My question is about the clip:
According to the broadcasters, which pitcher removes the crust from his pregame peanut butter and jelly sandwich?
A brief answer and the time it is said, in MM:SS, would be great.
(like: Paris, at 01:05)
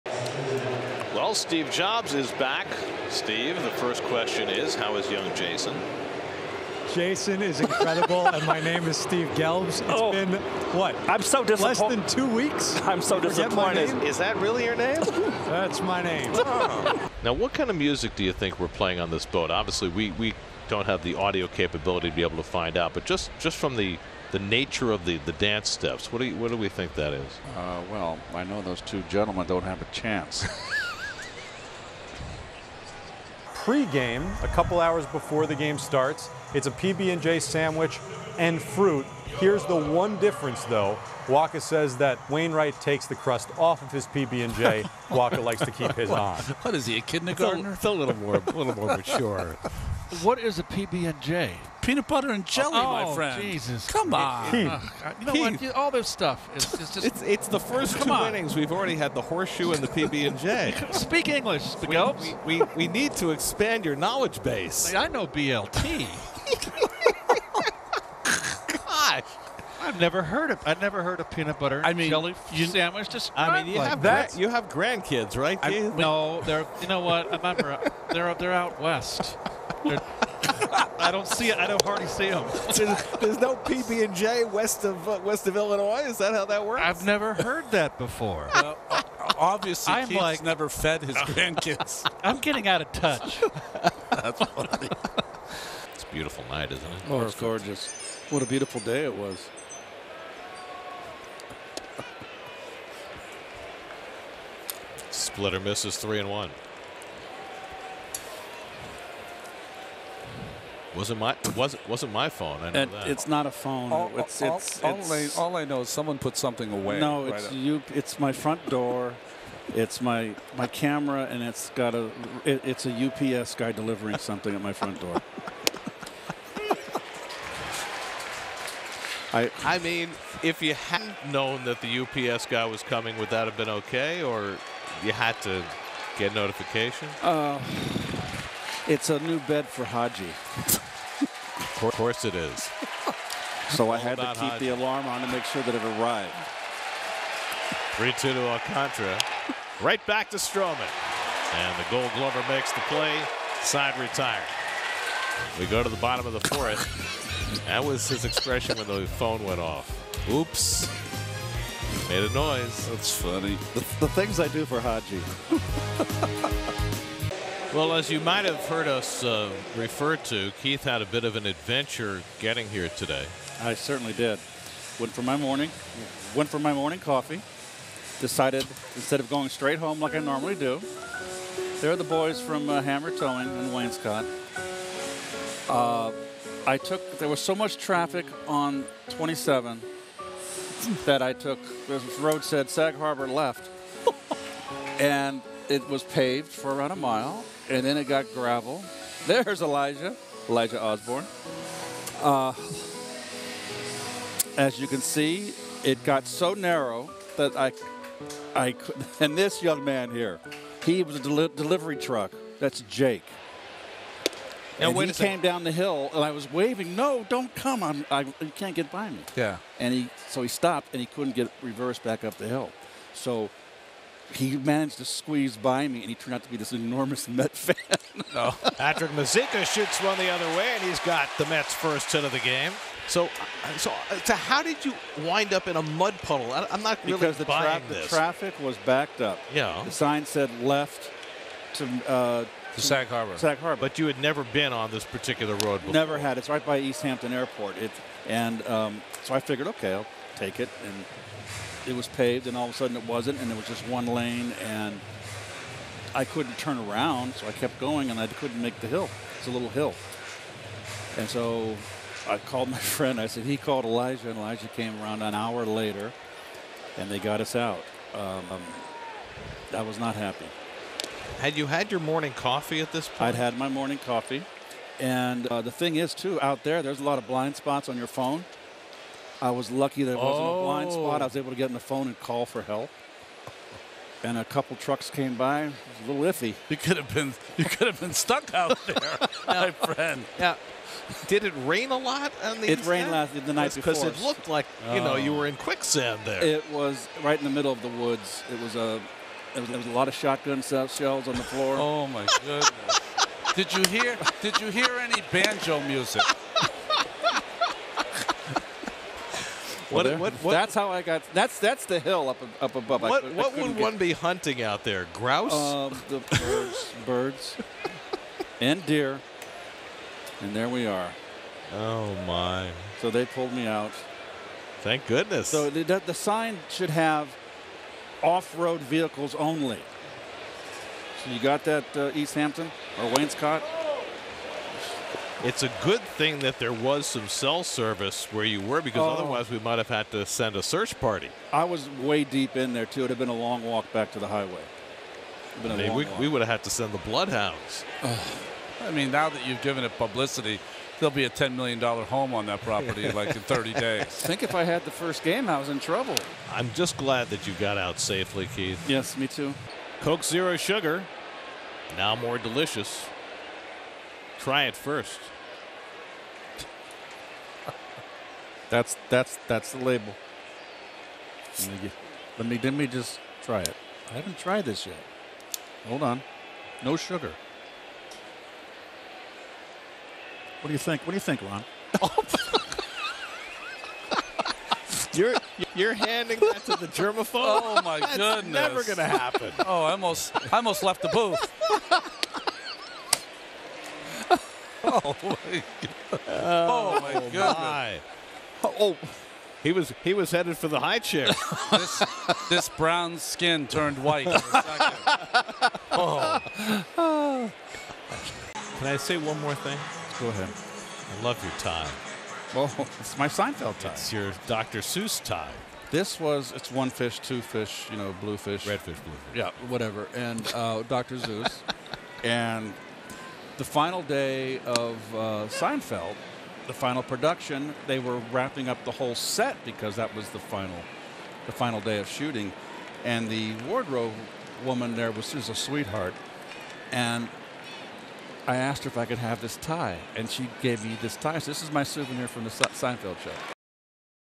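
Wainwright, at 00:42.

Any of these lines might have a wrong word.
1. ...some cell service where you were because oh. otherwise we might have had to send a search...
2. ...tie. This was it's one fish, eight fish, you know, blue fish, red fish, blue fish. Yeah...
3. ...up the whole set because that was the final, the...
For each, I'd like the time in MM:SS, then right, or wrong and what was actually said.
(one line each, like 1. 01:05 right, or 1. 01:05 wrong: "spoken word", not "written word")
1. 05:37 right
2. 06:55 wrong: "two", not "eight"
3. 07:08 right.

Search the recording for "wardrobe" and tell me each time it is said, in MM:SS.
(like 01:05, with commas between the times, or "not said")
07:13.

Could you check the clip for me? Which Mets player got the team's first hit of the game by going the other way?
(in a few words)
Patrick Mazeika.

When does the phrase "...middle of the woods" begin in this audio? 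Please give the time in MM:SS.
04:57.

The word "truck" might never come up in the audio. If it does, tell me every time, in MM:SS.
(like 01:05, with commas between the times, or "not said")
03:31, 04:44.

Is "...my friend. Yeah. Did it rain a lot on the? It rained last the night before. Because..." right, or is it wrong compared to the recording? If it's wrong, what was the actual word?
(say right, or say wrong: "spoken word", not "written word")
right.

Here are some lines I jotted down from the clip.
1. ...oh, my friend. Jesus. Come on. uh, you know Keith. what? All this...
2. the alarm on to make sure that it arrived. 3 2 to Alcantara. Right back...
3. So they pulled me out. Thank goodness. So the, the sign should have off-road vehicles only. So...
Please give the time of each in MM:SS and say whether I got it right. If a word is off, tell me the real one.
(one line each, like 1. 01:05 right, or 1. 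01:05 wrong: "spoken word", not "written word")
1. 00:52 right
2. 02:24 right
3. 05:23 right.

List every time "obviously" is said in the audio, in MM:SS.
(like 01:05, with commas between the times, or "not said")
00:19, 01:29.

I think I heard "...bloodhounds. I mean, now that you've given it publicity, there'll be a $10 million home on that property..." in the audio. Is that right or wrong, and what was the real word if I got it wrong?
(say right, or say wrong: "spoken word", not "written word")
right.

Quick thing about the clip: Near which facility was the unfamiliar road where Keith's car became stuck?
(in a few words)
East Hampton Airport.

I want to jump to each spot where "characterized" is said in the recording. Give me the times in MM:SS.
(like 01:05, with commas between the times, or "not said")
not said.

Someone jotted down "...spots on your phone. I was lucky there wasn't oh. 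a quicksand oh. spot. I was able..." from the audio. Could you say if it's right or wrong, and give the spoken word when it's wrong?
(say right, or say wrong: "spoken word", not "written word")
wrong: "blind", not "quicksand".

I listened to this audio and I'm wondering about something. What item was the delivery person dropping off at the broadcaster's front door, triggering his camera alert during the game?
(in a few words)
A new bed for Hadji.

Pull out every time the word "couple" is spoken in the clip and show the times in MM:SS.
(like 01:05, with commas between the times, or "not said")
00:34, 04:44.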